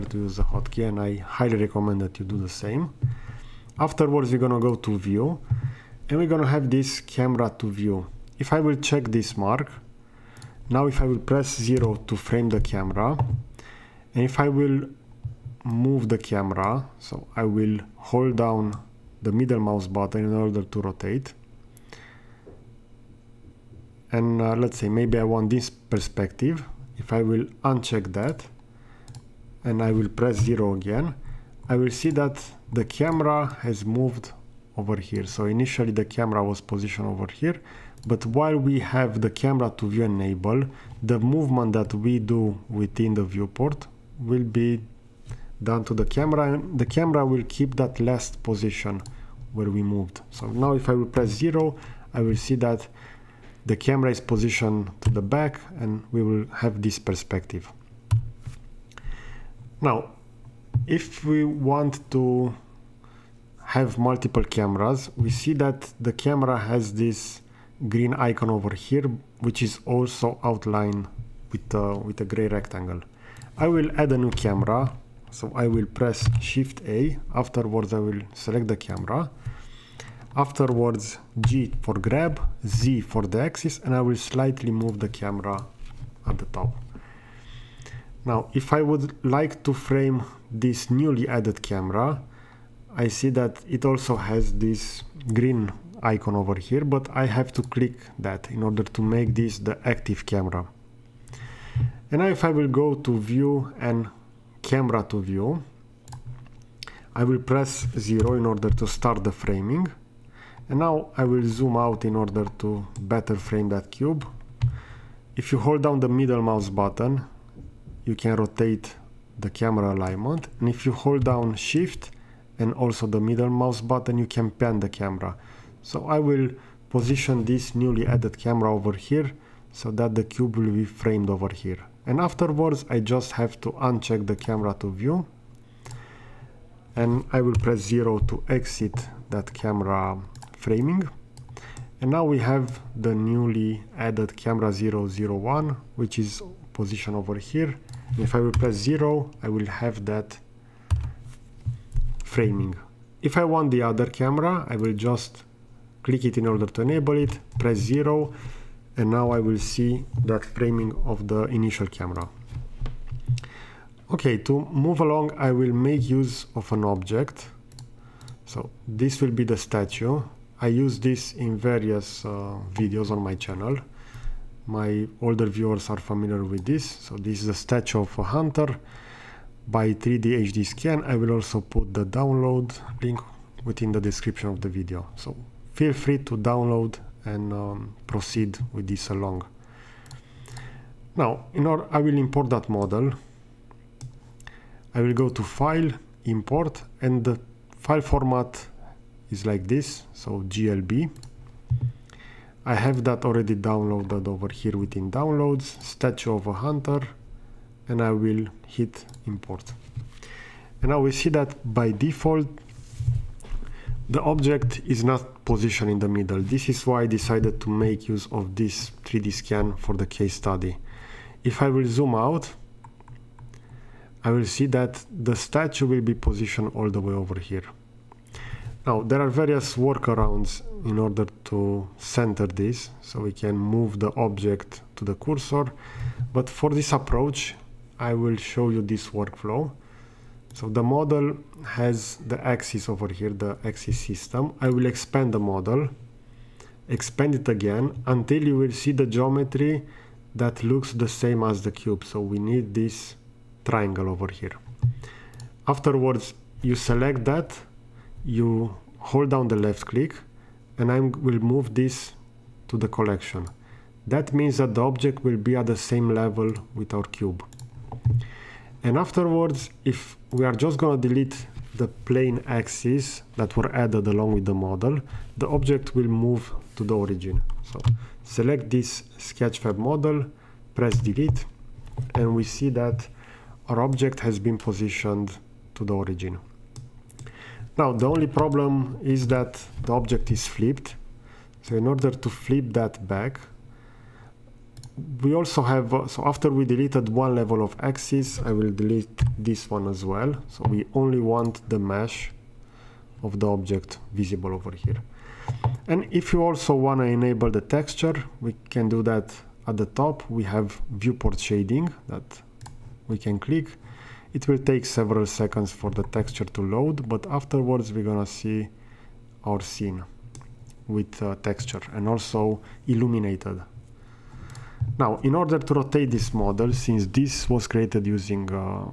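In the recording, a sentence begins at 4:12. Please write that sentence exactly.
So we need this triangle over here.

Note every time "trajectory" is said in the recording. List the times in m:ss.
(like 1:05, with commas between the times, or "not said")
not said.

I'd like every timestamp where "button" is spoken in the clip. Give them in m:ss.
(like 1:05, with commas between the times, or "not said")
0:19, 1:56, 2:03.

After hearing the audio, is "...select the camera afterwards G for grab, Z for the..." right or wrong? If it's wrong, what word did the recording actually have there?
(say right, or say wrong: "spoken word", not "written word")
right.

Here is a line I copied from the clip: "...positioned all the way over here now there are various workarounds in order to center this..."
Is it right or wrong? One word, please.
right.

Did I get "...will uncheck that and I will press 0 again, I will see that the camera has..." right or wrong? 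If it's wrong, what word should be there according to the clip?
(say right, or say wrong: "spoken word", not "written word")
right.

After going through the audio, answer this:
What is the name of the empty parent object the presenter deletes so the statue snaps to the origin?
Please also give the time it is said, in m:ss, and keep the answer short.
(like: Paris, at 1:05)
sketchfab model, at 4:39.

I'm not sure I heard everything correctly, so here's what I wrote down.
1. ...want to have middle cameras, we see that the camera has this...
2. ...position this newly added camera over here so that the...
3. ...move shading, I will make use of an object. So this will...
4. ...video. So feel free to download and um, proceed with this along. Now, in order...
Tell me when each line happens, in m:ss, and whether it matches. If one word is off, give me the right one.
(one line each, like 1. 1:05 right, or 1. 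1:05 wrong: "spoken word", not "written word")
1. 1:01 wrong: "multiple", not "middle"
2. 2:06 right
3. 2:44 wrong: "along", not "shading"
4. 3:04 right.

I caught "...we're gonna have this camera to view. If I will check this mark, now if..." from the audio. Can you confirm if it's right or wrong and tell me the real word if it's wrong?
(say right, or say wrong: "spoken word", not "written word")
right.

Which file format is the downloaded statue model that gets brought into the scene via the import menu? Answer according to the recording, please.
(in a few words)
glb.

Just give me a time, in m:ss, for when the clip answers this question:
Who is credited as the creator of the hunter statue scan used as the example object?
2:59.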